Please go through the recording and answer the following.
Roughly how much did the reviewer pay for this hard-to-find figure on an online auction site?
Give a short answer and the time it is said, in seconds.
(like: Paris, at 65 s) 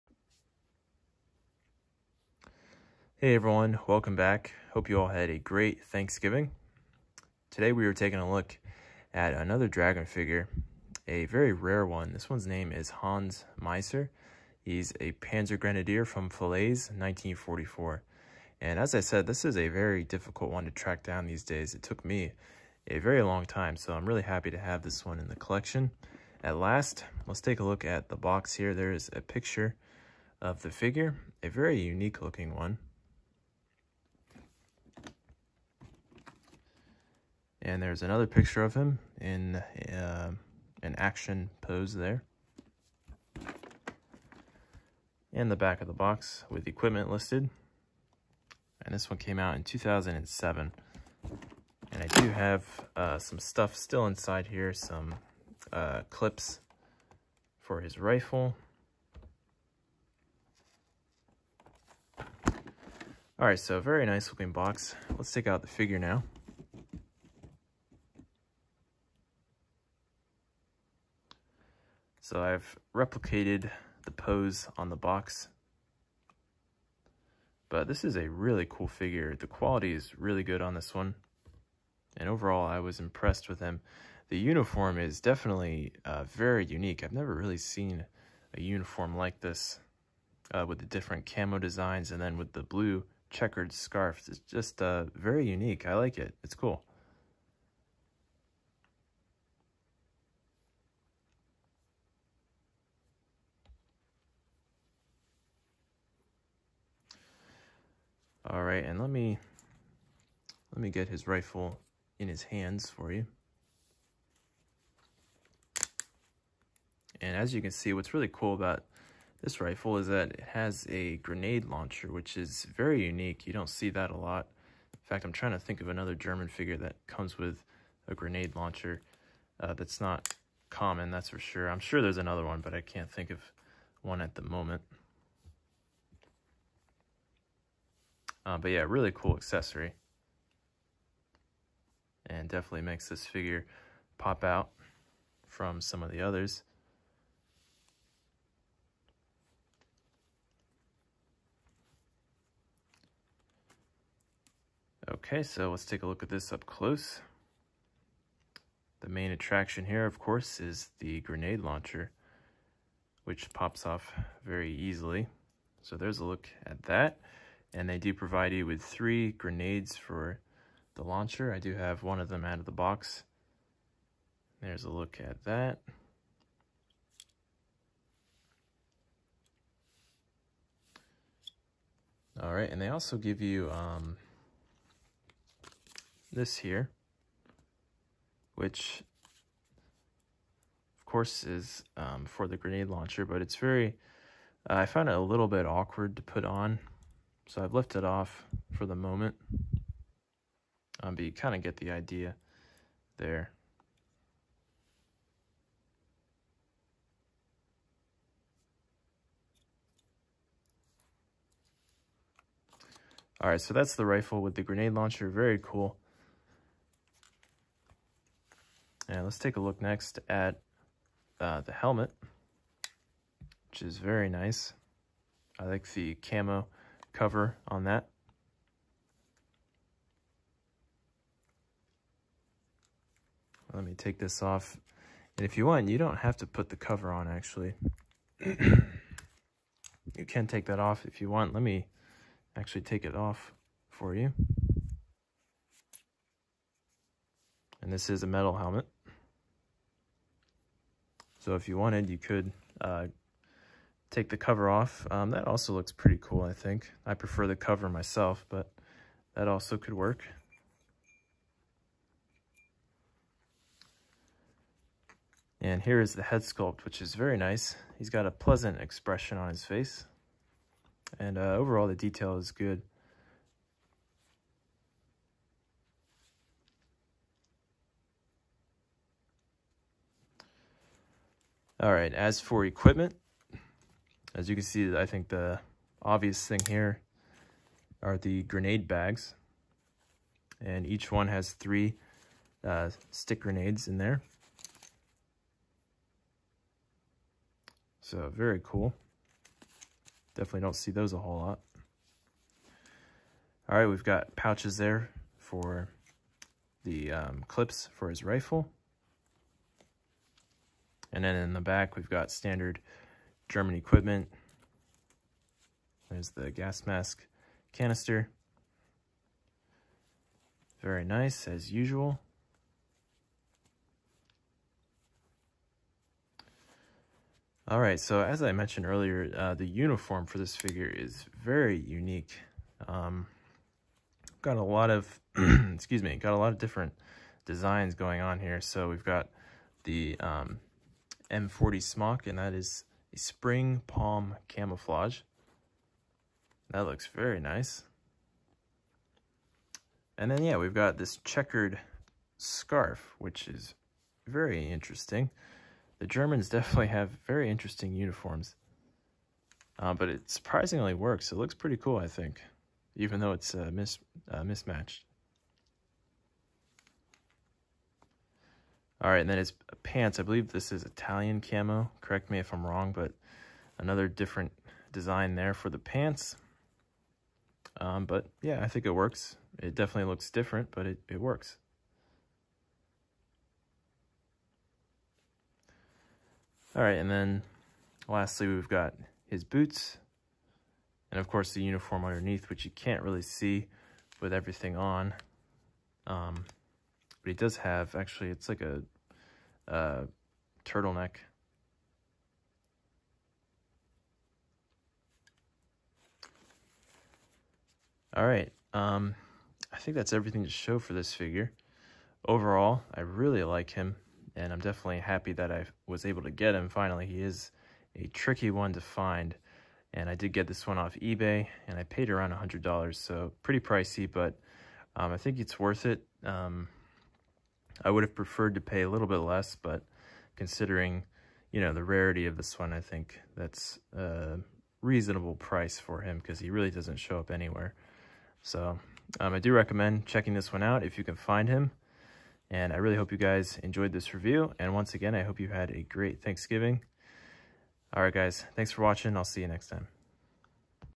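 $100, at 422 s.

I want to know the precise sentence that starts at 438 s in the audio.
So um, I do recommend checking this one out if you can find him.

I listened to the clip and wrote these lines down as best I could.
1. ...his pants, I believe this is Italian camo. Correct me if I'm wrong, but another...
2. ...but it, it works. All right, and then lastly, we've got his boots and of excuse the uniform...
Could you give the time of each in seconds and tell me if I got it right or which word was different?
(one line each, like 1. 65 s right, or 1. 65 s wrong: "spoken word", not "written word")
1. 369 s right
2. 380 s wrong: "course", not "excuse".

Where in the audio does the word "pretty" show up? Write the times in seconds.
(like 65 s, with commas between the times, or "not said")
255 s, 361 s, 423 s.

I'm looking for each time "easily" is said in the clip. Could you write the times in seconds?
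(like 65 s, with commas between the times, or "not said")
164 s.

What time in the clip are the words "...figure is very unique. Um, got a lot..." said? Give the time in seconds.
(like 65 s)
330 s.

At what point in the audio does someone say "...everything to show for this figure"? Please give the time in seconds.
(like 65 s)
410 s.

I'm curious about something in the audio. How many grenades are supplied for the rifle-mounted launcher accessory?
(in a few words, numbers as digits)
3.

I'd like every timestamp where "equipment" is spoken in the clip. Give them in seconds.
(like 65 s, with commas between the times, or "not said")
46 s, 282 s, 313 s.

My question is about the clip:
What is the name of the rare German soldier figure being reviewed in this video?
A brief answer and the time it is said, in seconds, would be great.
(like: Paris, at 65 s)
Hans Meisser, at 12 s.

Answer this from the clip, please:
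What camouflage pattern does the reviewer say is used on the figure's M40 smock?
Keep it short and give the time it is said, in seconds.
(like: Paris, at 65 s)
Spring palm, at 343 s.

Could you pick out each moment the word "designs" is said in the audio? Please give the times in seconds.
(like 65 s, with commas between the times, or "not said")
91 s, 337 s, 374 s.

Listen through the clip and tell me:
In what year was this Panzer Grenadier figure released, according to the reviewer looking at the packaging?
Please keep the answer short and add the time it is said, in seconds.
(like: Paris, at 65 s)
2007, at 49 s.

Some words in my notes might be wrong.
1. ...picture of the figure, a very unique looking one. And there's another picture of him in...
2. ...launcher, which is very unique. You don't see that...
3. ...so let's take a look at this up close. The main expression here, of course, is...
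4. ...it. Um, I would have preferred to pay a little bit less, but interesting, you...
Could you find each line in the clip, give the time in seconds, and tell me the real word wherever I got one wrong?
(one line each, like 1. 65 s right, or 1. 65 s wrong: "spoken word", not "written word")
1. 29 s right
2. 121 s right
3. 155 s wrong: "attraction", not "expression"
4. 425 s wrong: "considering", not "interesting".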